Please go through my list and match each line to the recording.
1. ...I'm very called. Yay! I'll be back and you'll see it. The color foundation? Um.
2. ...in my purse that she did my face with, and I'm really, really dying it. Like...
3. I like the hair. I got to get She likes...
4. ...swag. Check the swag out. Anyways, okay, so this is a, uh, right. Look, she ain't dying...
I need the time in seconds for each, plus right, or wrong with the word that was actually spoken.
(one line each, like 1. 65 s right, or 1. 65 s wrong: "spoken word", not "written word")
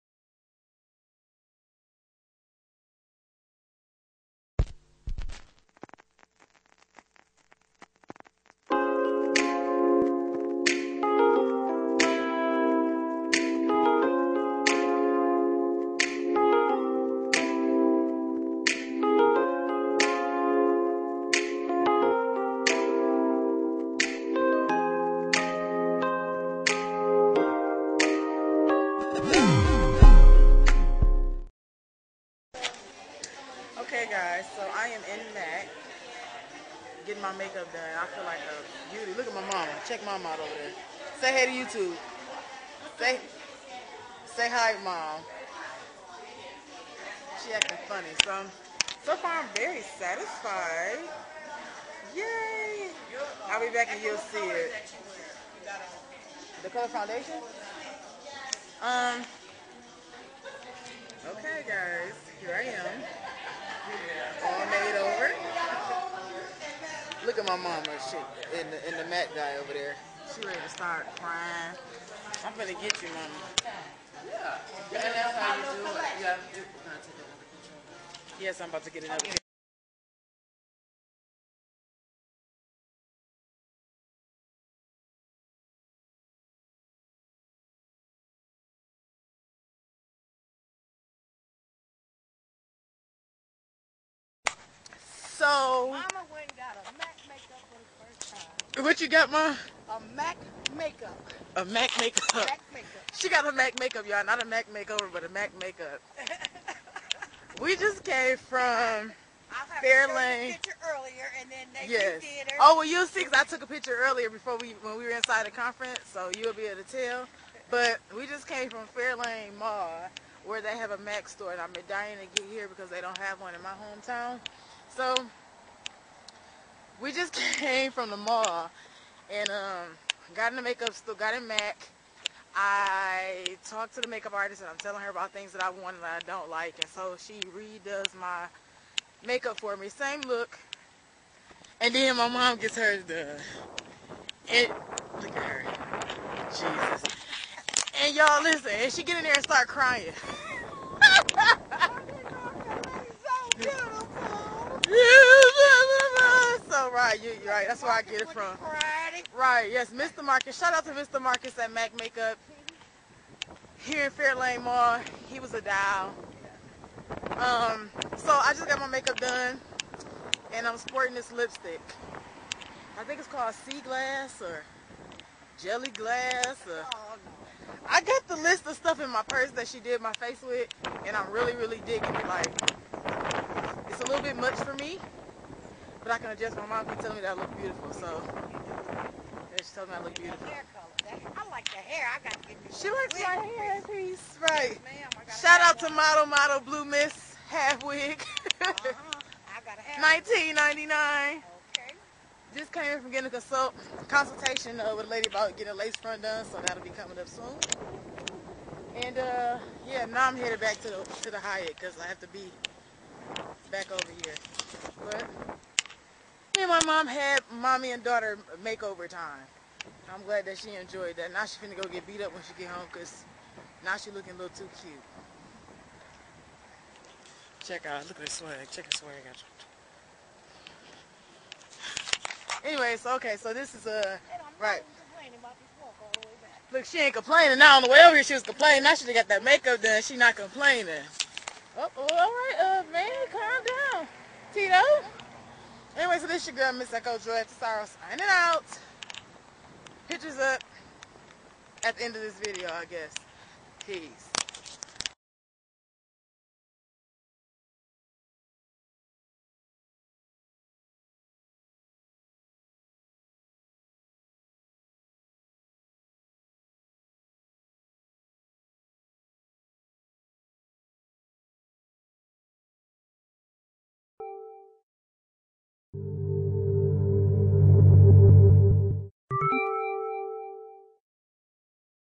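1. 49 s wrong: "satisfied", not "called"
2. 178 s wrong: "digging", not "dying"
3. 191 s right
4. 228 s wrong: "complaining", not "dying".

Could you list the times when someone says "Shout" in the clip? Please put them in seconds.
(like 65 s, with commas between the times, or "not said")
160 s, 195 s.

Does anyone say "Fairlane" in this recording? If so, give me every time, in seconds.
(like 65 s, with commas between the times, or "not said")
109 s, 118 s, 164 s.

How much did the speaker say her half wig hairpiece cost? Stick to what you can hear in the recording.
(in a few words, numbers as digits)
$19.99.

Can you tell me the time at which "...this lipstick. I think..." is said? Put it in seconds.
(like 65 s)
171 s.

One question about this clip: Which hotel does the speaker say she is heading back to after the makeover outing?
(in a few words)
the Hyatt.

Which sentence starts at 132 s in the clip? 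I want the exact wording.
I talked to the makeup artist and I'm telling her about things that I want and I don't like.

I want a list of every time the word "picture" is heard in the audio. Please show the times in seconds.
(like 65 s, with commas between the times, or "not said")
113 s, 250 s.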